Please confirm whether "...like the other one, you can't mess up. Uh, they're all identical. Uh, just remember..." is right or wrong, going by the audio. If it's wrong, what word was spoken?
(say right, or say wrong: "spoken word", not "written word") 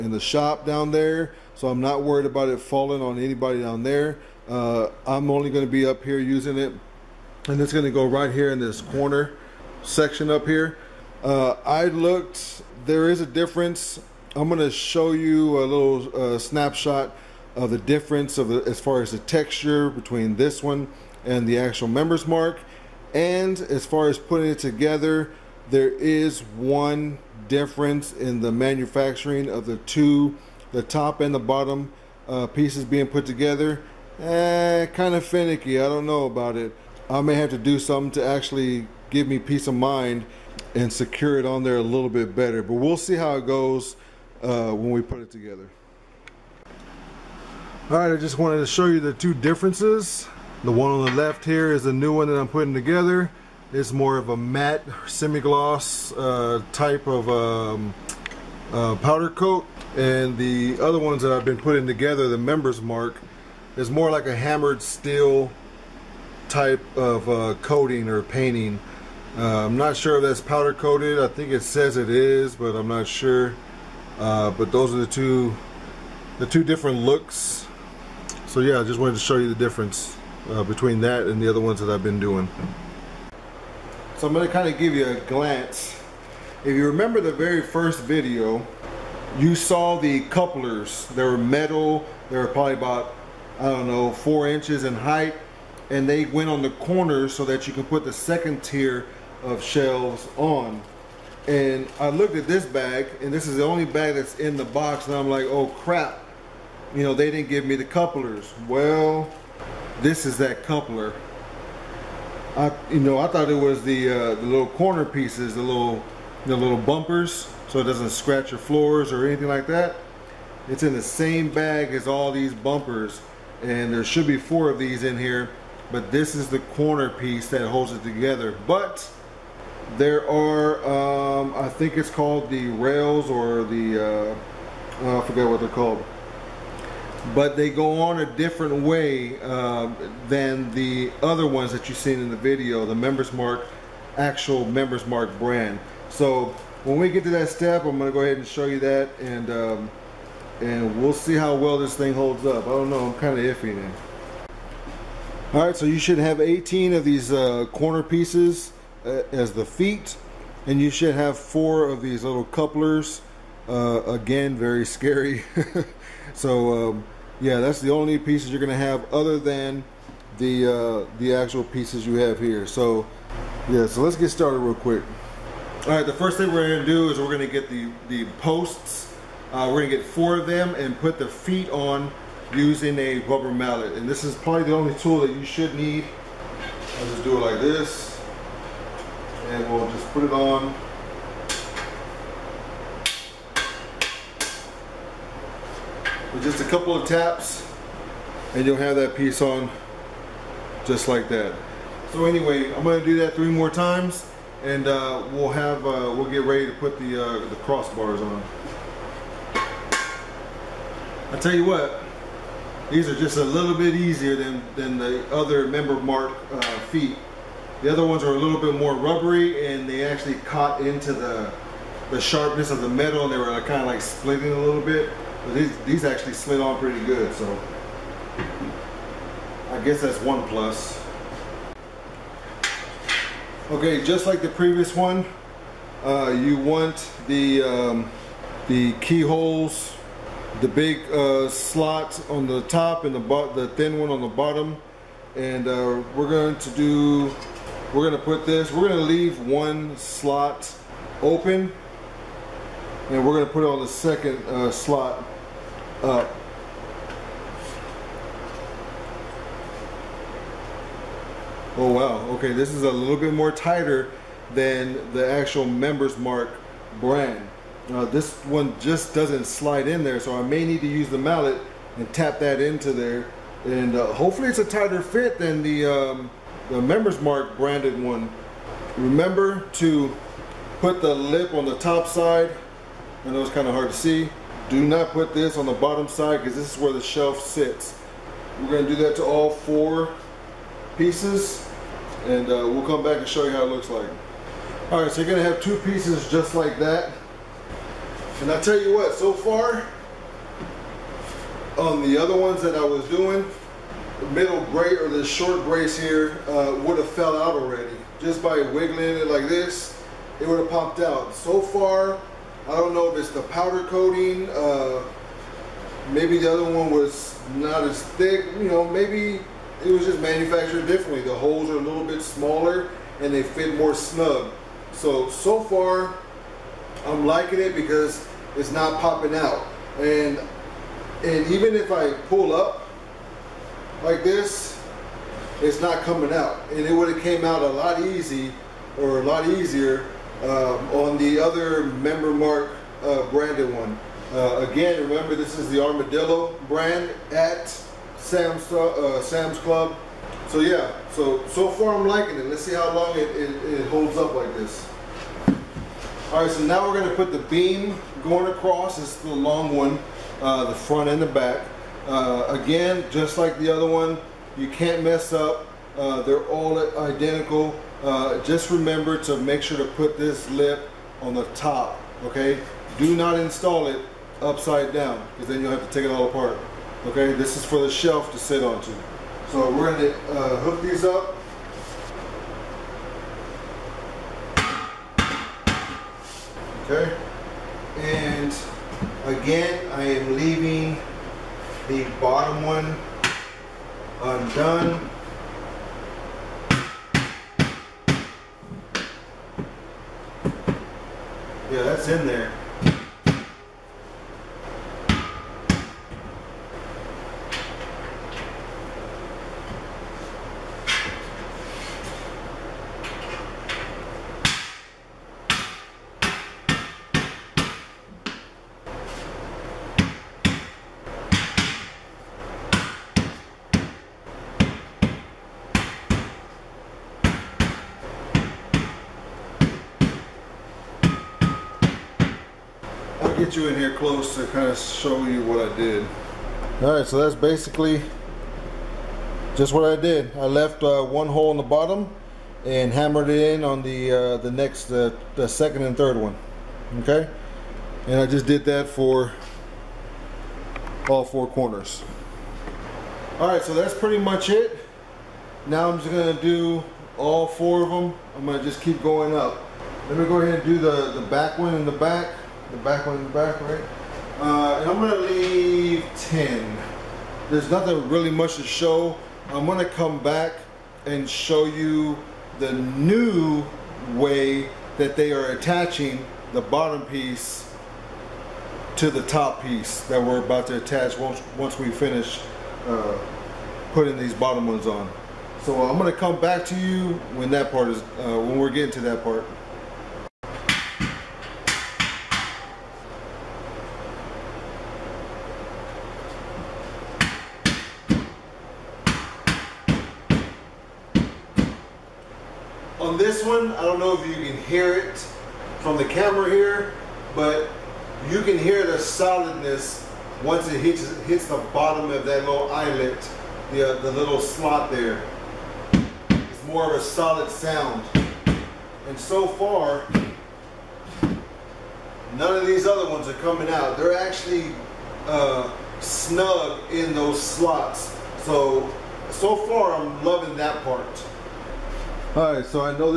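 right.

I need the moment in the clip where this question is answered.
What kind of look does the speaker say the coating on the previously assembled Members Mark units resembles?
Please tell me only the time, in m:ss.
1:04.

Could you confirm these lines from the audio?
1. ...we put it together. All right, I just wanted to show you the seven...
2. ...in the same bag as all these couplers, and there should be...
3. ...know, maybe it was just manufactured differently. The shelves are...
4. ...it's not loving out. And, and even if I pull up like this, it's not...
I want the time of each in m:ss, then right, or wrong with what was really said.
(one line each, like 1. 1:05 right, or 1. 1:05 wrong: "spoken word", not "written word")
1. 0:44 wrong: "two", not "seven"
2. 2:00 wrong: "bumpers", not "couplers"
3. 5:18 wrong: "holes", not "shelves"
4. 5:28 wrong: "popping", not "loving".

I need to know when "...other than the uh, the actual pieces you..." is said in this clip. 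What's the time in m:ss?
2:49.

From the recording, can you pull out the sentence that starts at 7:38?
I'm gonna just keep going up.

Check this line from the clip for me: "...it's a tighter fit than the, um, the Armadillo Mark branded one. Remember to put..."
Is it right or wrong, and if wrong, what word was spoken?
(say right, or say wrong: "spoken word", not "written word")
wrong: "Members", not "Armadillo".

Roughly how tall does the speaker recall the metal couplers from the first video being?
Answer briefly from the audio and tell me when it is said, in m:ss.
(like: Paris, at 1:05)
4 inches, at 1:34.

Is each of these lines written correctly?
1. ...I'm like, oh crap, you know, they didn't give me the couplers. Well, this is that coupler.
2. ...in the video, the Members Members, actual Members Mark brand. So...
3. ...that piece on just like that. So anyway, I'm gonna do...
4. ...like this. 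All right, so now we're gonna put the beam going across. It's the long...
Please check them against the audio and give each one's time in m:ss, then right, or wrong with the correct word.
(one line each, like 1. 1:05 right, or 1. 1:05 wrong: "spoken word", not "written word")
1. 1:45 right
2. 2:22 wrong: "Mark", not "Members"
3. 3:18 right
4. 5:54 right.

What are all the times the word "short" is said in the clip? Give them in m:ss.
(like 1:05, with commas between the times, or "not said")
5:05.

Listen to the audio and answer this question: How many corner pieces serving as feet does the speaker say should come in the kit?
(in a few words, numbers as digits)
18.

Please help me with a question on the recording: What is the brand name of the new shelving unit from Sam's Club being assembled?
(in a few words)
Armadillo.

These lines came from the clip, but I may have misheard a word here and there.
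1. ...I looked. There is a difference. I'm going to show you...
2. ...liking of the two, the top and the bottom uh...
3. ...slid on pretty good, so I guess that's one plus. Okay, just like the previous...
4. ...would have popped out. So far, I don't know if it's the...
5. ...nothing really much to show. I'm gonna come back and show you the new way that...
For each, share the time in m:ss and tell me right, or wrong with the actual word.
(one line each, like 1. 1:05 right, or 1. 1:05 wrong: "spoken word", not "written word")
1. 0:11 right
2. 0:28 wrong: "manufacturing", not "liking"
3. 3:46 right
4. 5:10 right
5. 7:47 right.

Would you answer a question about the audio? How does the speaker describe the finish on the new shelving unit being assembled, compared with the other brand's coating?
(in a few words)
matte semi-gloss.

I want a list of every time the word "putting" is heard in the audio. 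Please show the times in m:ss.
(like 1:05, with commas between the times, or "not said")
0:24, 0:52, 1:01, 8:03.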